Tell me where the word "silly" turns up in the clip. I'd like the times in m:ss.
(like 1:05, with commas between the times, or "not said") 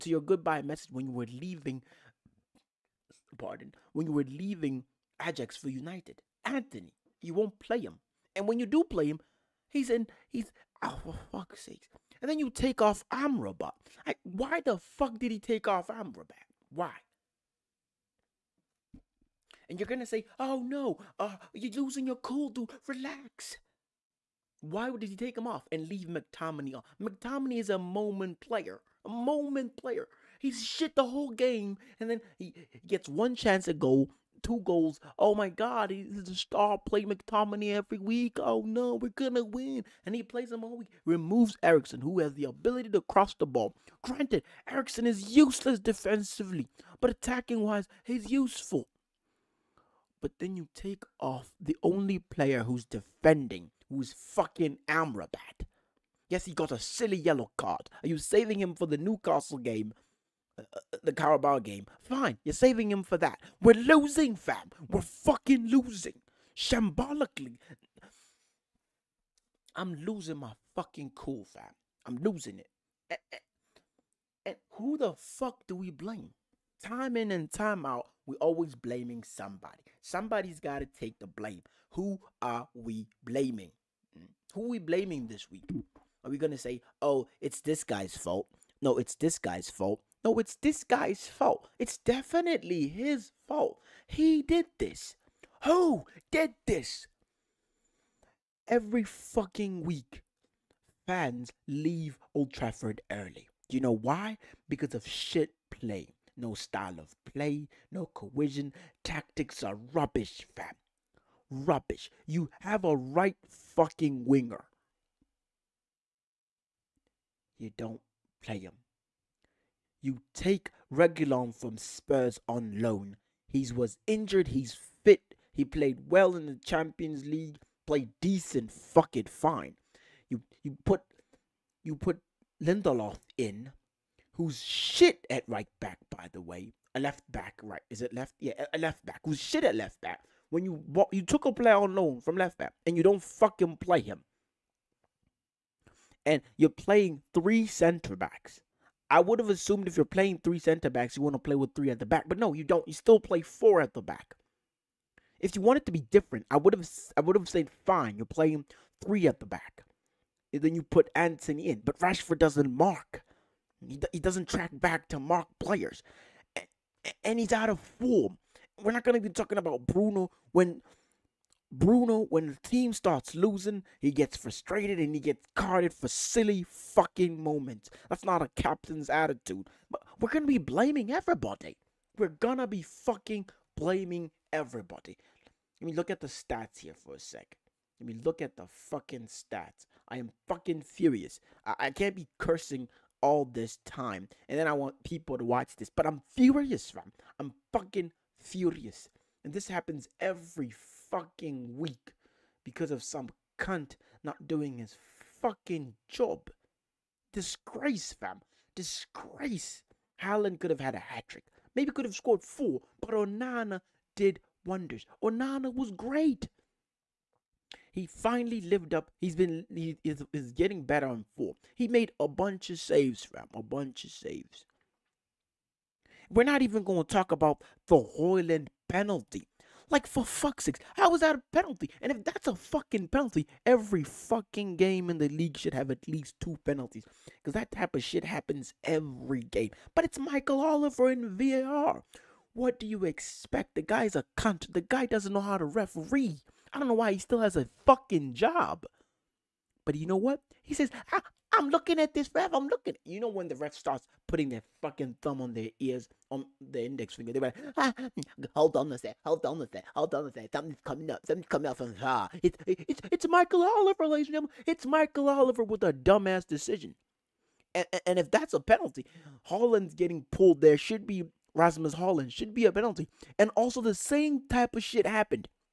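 0:56, 2:56.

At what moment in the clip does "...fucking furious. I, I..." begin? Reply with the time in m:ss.
3:10.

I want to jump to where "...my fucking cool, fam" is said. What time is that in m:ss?
1:10.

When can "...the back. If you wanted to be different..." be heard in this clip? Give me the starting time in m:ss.
2:33.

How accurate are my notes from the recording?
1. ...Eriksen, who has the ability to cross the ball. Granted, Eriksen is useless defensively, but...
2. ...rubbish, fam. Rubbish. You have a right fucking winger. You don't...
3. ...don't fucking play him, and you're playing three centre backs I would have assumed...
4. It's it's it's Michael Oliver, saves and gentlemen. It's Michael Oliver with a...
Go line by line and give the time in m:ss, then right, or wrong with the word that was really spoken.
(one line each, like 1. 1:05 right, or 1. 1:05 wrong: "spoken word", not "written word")
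1. 0:41 right
2. 1:49 right
3. 2:23 right
4. 4:22 wrong: "ladies", not "saves".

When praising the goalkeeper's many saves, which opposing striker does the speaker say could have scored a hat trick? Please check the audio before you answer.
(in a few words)
Haaland.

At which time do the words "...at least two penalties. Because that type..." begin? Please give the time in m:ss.
3:55.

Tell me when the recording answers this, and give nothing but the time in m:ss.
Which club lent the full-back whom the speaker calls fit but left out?
2:01.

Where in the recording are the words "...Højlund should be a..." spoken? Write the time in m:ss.
4:31.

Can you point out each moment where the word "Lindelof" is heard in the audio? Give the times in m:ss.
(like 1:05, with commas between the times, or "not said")
2:12.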